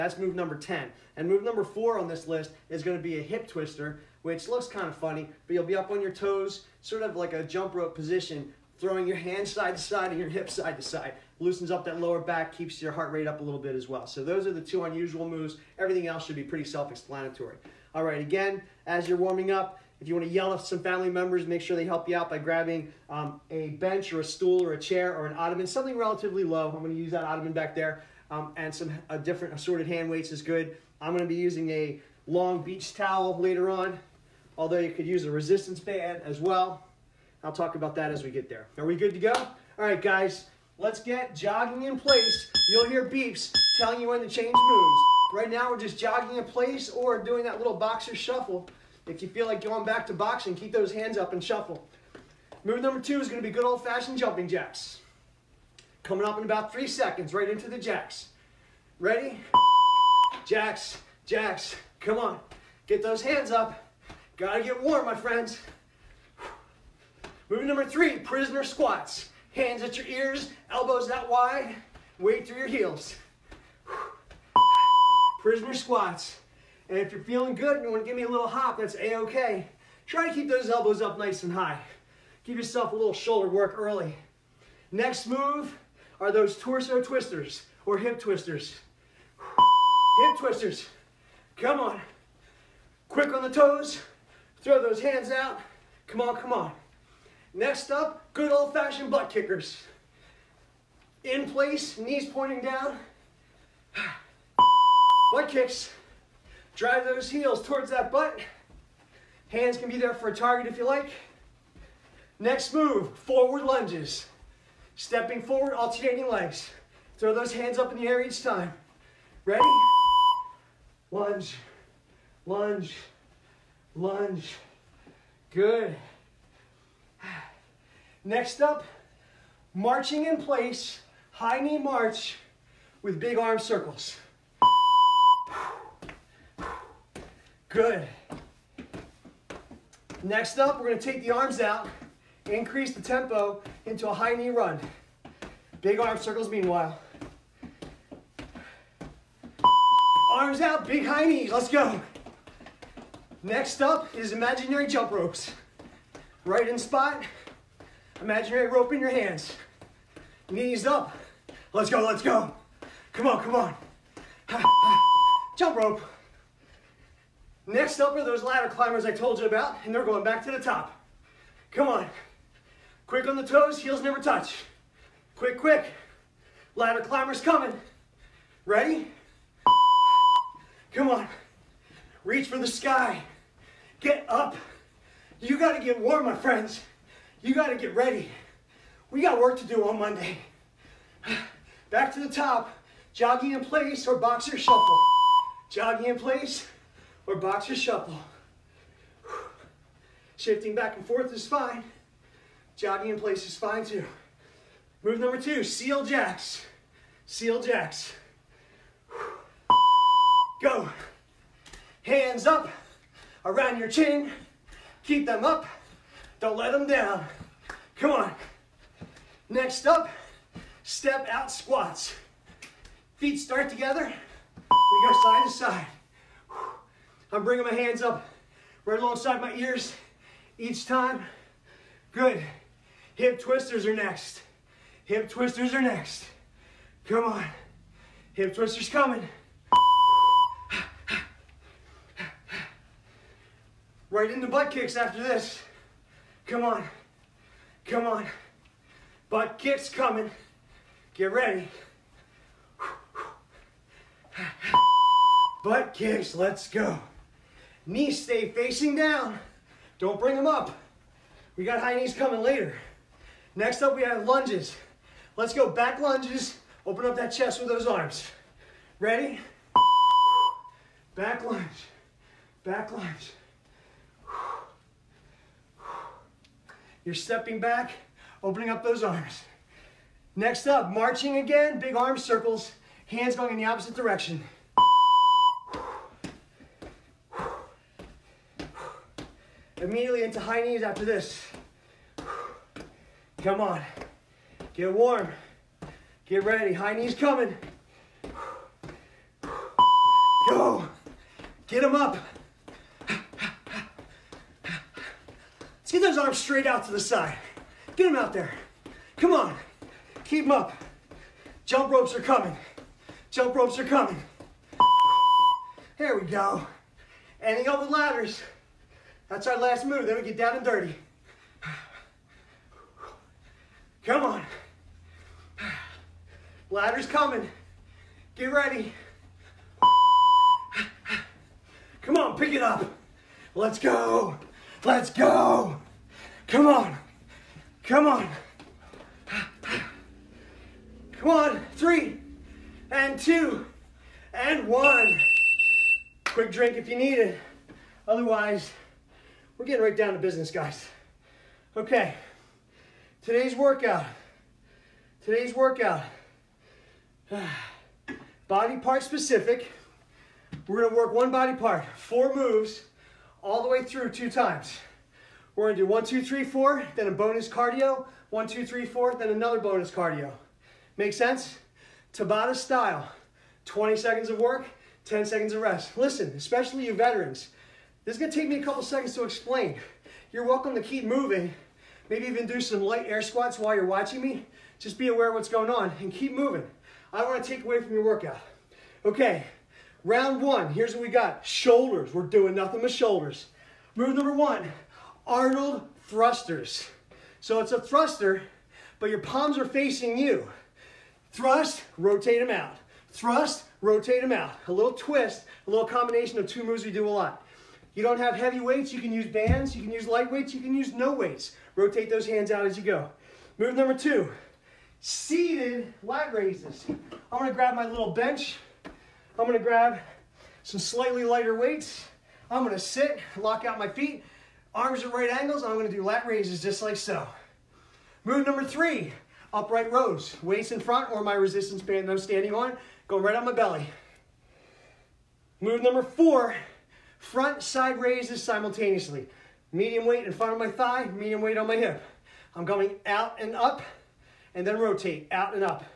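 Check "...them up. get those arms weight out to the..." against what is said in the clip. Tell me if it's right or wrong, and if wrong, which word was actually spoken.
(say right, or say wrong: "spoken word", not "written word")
wrong: "straight", not "weight".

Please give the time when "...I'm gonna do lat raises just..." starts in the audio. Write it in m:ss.
7:05.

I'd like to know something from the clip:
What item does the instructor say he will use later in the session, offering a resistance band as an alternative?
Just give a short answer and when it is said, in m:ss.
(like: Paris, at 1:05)
long beach towel, at 0:32.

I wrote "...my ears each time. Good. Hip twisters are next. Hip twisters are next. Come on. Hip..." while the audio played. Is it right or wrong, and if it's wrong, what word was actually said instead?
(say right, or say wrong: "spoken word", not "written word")
right.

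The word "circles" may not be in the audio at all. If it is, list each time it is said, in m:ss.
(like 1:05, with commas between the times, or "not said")
2:13, 2:26, 4:42.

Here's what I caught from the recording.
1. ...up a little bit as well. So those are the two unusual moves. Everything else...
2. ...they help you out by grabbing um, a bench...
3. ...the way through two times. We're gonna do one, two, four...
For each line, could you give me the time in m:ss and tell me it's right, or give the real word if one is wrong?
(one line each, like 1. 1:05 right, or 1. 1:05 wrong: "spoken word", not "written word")
1. 0:13 right
2. 0:21 right
3. 6:03 wrong: "three", not "four".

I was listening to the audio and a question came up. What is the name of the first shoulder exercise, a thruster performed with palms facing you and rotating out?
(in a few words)
Arnold thrusters.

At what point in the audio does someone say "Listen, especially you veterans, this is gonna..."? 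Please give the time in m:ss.
6:15.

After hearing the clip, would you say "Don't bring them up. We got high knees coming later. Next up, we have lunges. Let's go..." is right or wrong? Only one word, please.
right.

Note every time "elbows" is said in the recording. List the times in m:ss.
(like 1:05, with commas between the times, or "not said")
1:10, 1:20.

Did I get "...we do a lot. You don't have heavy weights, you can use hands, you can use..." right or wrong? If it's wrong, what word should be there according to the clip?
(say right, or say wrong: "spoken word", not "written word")
wrong: "bands", not "hands".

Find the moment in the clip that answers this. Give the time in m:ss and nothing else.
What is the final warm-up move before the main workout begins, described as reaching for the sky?
5:17.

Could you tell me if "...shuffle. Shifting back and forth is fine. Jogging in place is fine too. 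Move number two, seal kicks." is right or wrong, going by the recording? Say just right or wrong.
wrong.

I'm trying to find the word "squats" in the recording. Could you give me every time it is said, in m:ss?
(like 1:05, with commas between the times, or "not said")
1:08, 1:15, 3:41, 6:23.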